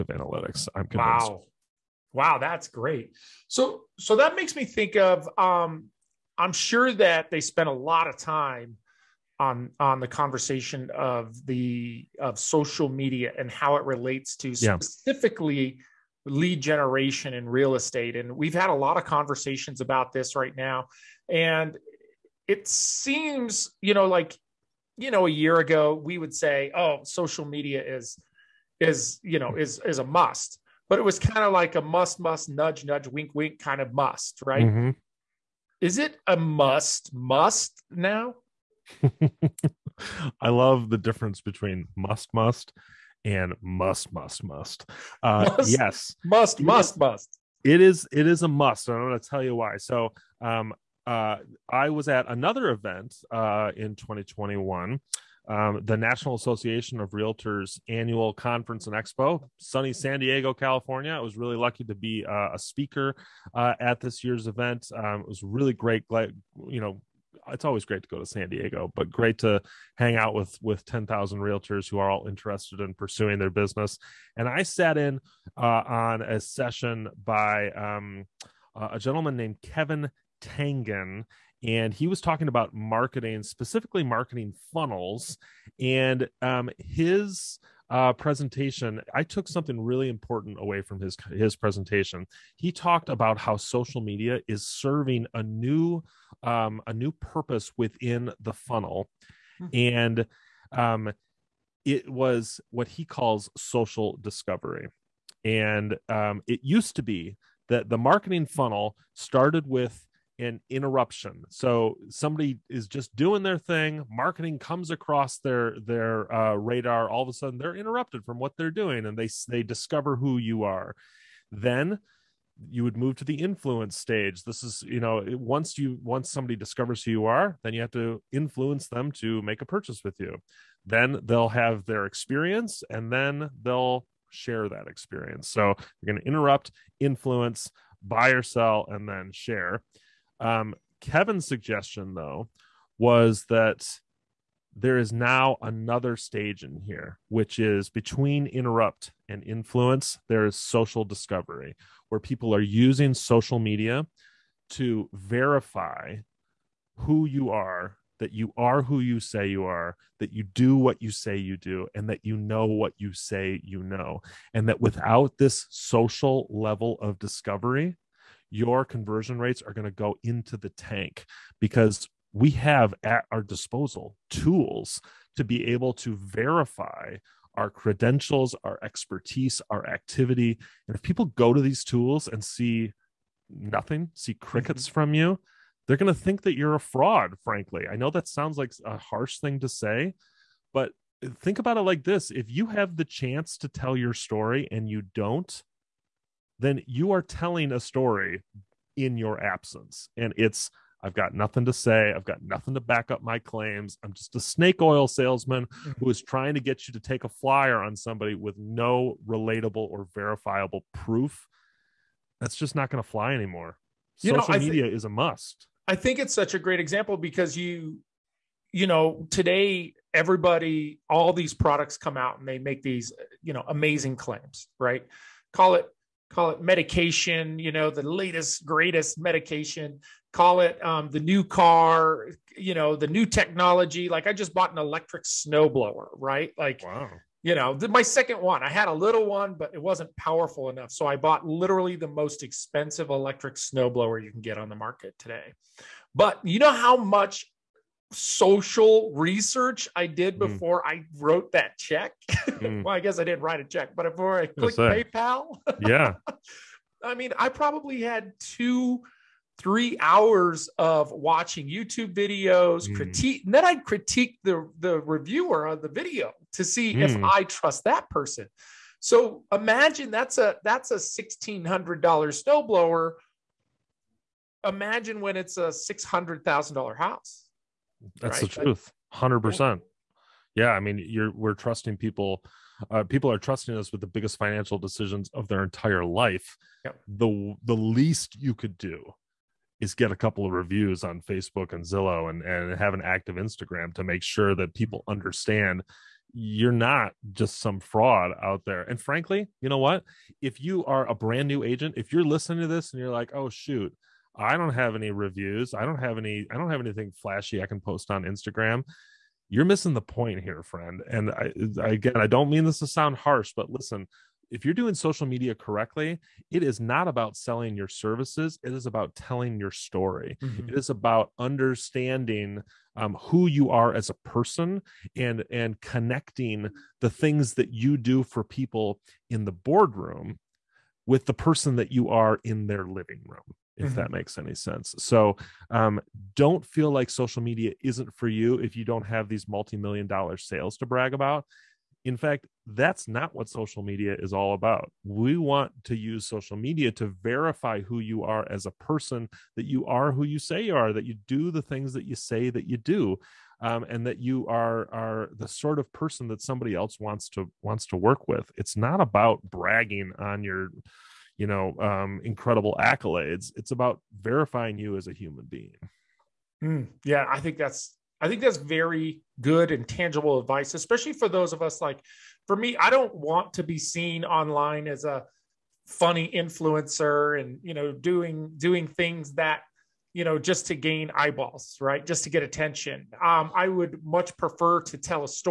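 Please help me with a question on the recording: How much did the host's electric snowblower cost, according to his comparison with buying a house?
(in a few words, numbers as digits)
$1,600.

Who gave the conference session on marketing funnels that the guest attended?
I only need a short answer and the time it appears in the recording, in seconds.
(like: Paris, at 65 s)
Kevin Tangen, at 79 s.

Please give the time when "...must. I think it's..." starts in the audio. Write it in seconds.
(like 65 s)
215 s.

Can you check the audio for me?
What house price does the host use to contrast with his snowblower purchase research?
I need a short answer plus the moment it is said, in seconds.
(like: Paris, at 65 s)
$600,000, at 275 s.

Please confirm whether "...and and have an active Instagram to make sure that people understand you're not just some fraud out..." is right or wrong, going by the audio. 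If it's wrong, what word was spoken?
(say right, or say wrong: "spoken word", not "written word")
right.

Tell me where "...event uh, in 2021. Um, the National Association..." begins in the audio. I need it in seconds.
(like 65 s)
52 s.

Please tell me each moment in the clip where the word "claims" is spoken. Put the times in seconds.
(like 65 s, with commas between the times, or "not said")
203 s, 224 s.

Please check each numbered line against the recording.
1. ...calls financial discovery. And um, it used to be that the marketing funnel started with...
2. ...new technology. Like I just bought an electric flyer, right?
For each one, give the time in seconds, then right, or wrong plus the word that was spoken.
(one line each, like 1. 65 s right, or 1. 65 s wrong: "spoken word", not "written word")
1. 103 s wrong: "social", not "financial"
2. 233 s wrong: "snowblower", not "flyer".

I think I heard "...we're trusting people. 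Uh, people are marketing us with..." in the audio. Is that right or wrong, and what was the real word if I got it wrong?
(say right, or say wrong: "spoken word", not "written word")
wrong: "trusting", not "marketing".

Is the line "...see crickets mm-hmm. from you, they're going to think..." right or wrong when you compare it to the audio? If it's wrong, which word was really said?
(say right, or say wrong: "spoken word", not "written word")
right.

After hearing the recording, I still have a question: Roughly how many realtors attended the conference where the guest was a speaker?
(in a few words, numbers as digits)
10,000.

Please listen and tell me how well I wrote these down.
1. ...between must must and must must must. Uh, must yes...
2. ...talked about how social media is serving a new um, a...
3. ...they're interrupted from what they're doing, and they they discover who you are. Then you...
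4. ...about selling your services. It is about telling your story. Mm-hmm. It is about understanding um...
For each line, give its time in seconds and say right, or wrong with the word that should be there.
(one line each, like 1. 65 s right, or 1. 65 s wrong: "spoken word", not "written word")
1. 41 s right
2. 92 s right
3. 117 s right
4. 317 s right.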